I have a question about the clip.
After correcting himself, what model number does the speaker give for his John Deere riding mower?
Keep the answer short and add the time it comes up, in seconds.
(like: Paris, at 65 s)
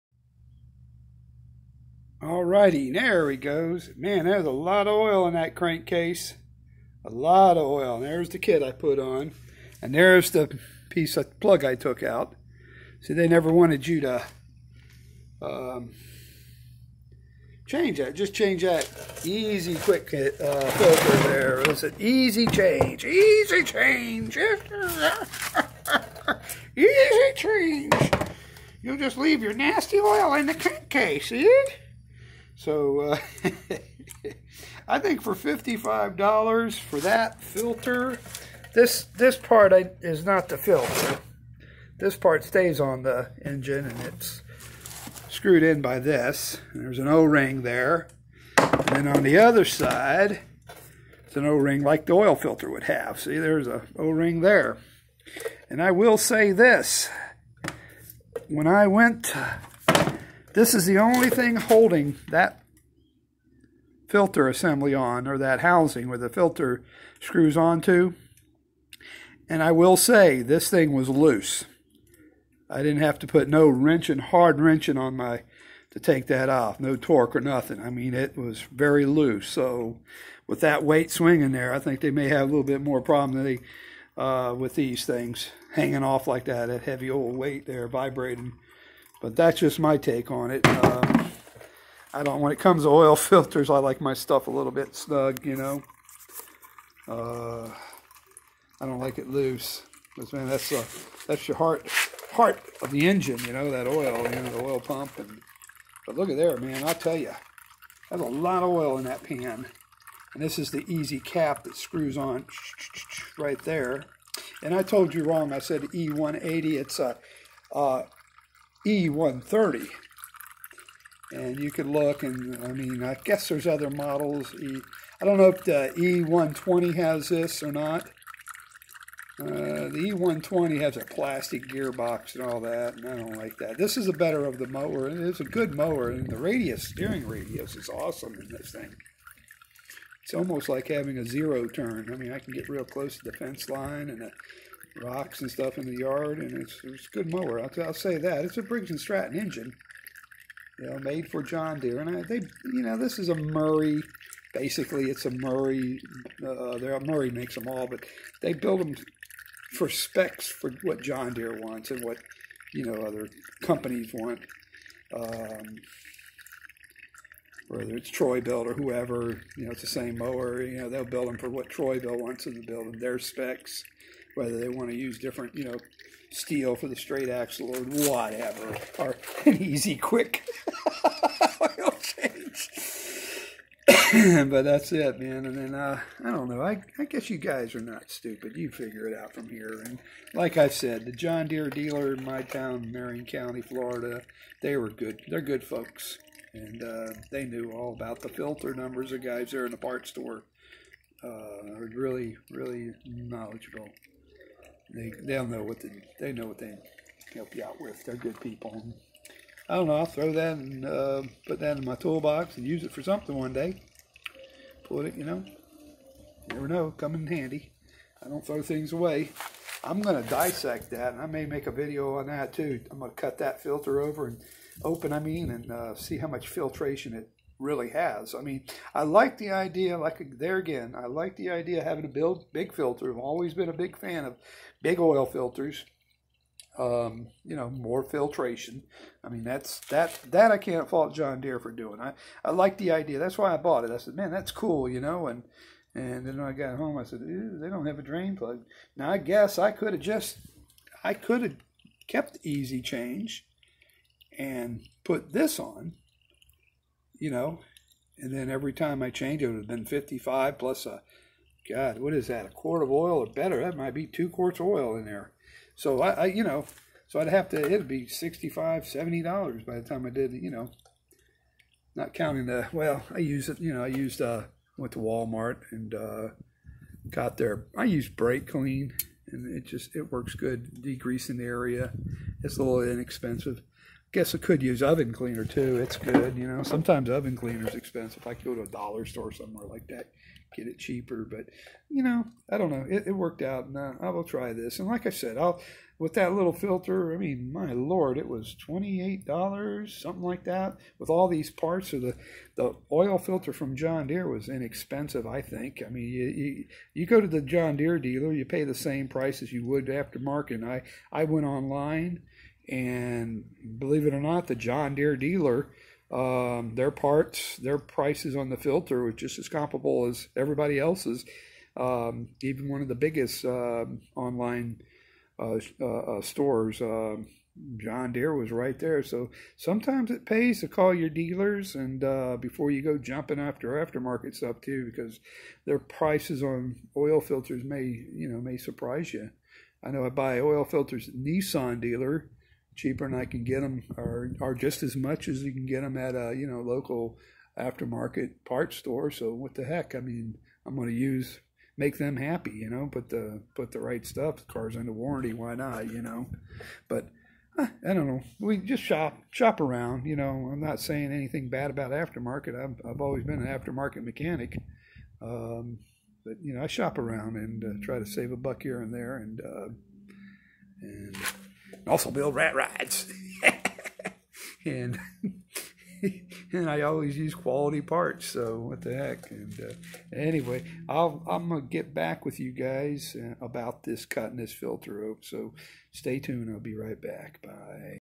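E130, at 118 s.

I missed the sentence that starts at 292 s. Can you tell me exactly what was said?
It, it worked out, and uh, I will try this.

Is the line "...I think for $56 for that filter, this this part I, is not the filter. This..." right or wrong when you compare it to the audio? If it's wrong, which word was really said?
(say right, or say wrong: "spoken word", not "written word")
wrong: "55", not "56".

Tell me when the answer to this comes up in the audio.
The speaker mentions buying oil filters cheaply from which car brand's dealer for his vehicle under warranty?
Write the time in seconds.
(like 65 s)
341 s.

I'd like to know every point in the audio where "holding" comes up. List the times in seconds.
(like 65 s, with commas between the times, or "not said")
61 s.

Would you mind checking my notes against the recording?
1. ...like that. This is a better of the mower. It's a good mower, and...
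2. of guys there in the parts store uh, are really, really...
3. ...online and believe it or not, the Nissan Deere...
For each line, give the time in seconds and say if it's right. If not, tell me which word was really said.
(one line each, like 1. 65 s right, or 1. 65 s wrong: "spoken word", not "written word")
1. 133 s right
2. 199 s right
3. 311 s wrong: "John", not "Nissan".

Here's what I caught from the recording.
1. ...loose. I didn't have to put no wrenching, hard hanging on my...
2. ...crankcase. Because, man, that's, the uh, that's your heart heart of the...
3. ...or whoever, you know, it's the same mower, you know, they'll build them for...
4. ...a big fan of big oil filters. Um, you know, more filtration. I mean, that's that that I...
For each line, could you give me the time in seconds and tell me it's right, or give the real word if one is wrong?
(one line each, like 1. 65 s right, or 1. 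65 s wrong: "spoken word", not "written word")
1. 71 s wrong: "wrenching", not "hanging"
2. 99 s wrong: "loose", not "crankcase"
3. 168 s right
4. 233 s right.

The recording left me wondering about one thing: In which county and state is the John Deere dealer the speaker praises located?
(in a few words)
Marion County, Florida.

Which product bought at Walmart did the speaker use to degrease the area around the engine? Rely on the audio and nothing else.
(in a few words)
brake clean.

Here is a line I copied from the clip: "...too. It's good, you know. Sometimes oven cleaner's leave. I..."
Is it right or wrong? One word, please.
wrong.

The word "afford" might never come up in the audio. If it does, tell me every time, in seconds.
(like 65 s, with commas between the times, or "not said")
not said.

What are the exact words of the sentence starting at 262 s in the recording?
A quart of oil or better?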